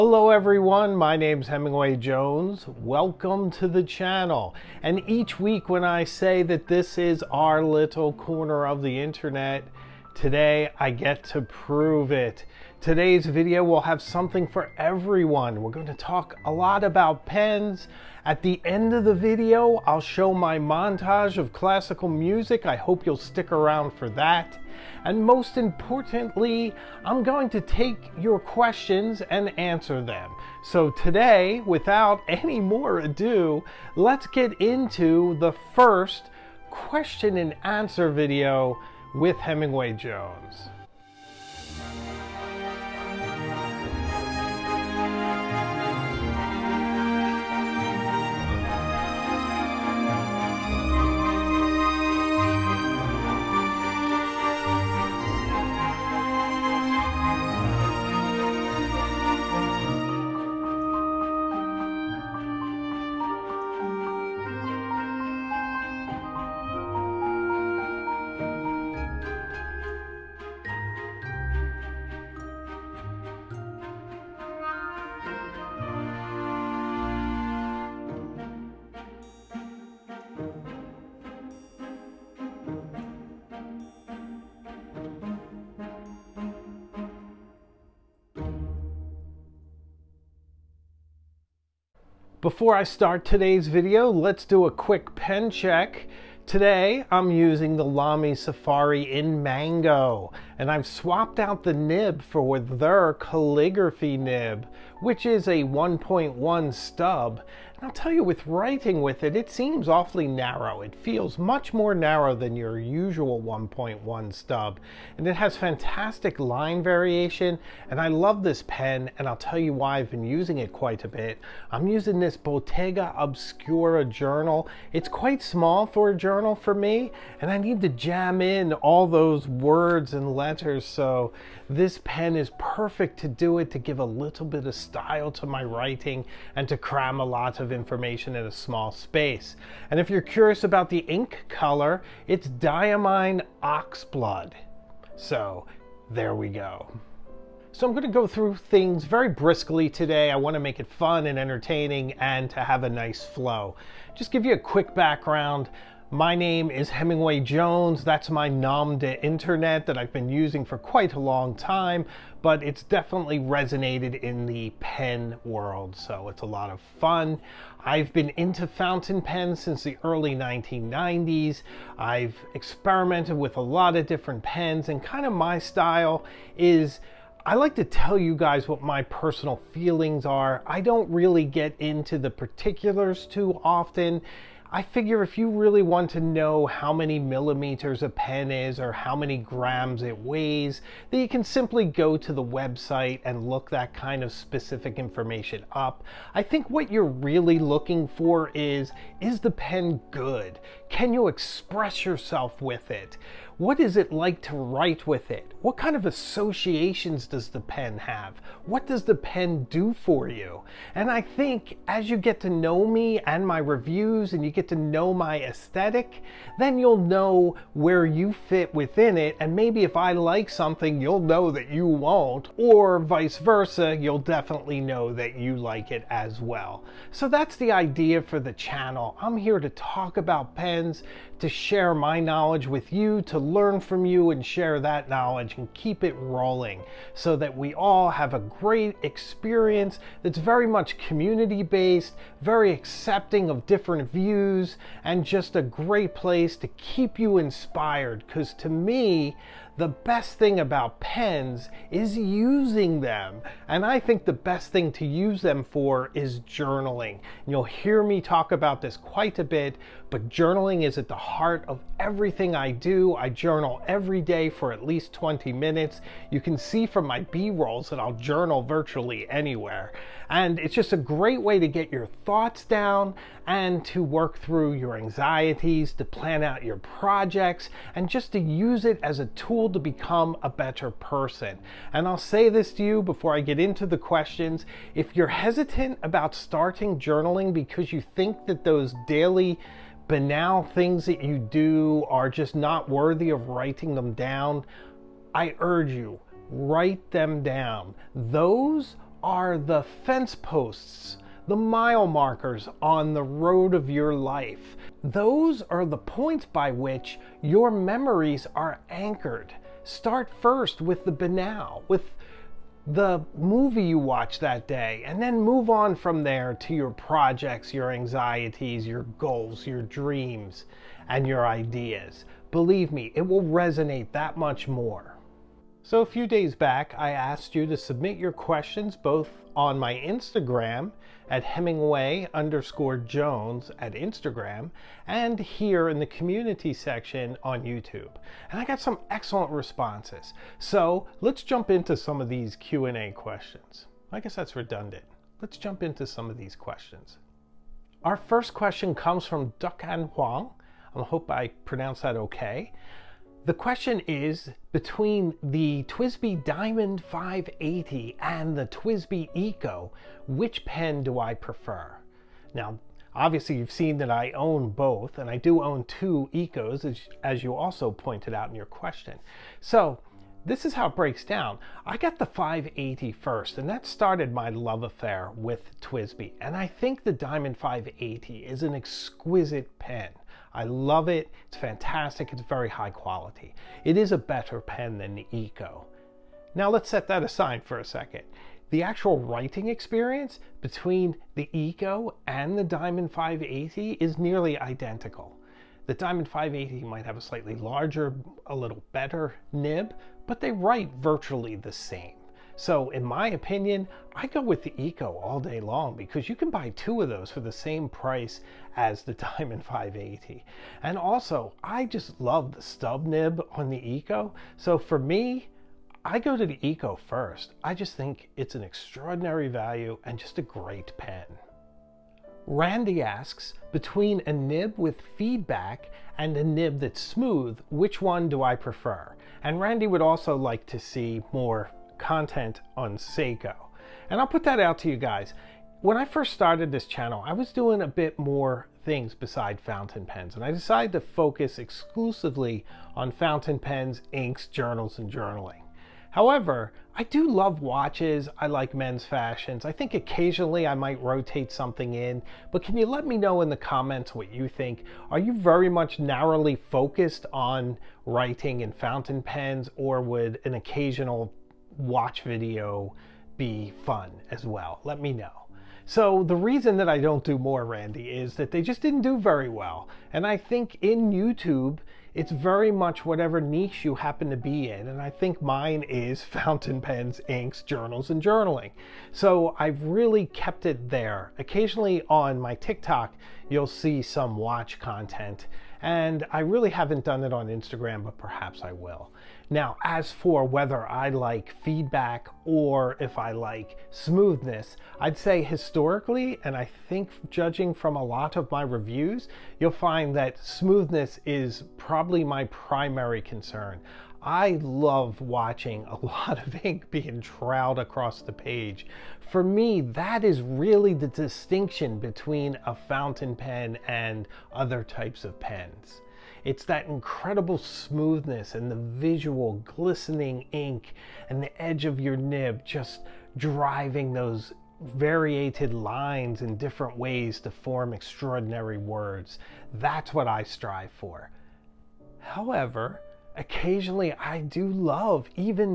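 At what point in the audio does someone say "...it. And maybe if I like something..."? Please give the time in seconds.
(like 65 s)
219 s.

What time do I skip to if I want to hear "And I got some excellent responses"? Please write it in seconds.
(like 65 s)
338 s.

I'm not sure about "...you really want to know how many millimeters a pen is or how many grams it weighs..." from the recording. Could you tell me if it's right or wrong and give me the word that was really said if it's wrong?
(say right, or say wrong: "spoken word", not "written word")
right.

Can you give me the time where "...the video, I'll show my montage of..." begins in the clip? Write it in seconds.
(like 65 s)
19 s.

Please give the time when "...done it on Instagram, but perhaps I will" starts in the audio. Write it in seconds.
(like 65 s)
487 s.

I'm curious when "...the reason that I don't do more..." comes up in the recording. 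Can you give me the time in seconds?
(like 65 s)
466 s.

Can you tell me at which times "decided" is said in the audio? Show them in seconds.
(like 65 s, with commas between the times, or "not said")
440 s.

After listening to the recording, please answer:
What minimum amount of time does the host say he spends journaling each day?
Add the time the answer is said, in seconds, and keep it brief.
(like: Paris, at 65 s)
20 minutes, at 265 s.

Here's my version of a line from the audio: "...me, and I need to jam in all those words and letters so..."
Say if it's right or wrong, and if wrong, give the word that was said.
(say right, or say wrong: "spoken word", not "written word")
right.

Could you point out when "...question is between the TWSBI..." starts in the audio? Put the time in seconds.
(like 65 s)
353 s.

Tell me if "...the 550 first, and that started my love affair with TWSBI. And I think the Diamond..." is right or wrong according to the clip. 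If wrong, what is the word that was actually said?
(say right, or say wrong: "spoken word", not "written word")
wrong: "580", not "550".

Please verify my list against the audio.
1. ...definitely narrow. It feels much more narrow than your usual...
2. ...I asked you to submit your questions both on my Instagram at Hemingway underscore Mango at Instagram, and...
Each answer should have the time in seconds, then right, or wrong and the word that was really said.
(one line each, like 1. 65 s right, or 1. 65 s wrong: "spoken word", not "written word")
1. 109 s wrong: "awfully", not "definitely"
2. 326 s wrong: "Jones", not "Mango".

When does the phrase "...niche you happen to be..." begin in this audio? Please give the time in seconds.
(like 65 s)
473 s.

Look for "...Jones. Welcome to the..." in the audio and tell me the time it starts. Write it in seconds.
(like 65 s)
1 s.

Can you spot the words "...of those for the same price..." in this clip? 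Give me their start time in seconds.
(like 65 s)
407 s.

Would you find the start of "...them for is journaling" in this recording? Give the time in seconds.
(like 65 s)
255 s.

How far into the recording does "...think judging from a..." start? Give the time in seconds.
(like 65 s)
496 s.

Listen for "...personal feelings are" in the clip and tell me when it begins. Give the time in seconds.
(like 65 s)
179 s.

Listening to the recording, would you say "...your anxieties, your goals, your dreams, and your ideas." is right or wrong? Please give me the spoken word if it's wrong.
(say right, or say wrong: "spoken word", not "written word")
right.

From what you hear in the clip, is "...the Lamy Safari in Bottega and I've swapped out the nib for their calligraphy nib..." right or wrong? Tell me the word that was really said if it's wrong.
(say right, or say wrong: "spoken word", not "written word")
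wrong: "Mango", not "Bottega".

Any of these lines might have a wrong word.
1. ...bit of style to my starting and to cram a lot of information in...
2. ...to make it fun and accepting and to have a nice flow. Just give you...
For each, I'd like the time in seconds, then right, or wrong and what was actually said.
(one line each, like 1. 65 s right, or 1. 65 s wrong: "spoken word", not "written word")
1. 134 s wrong: "writing", not "starting"
2. 150 s wrong: "entertaining", not "accepting".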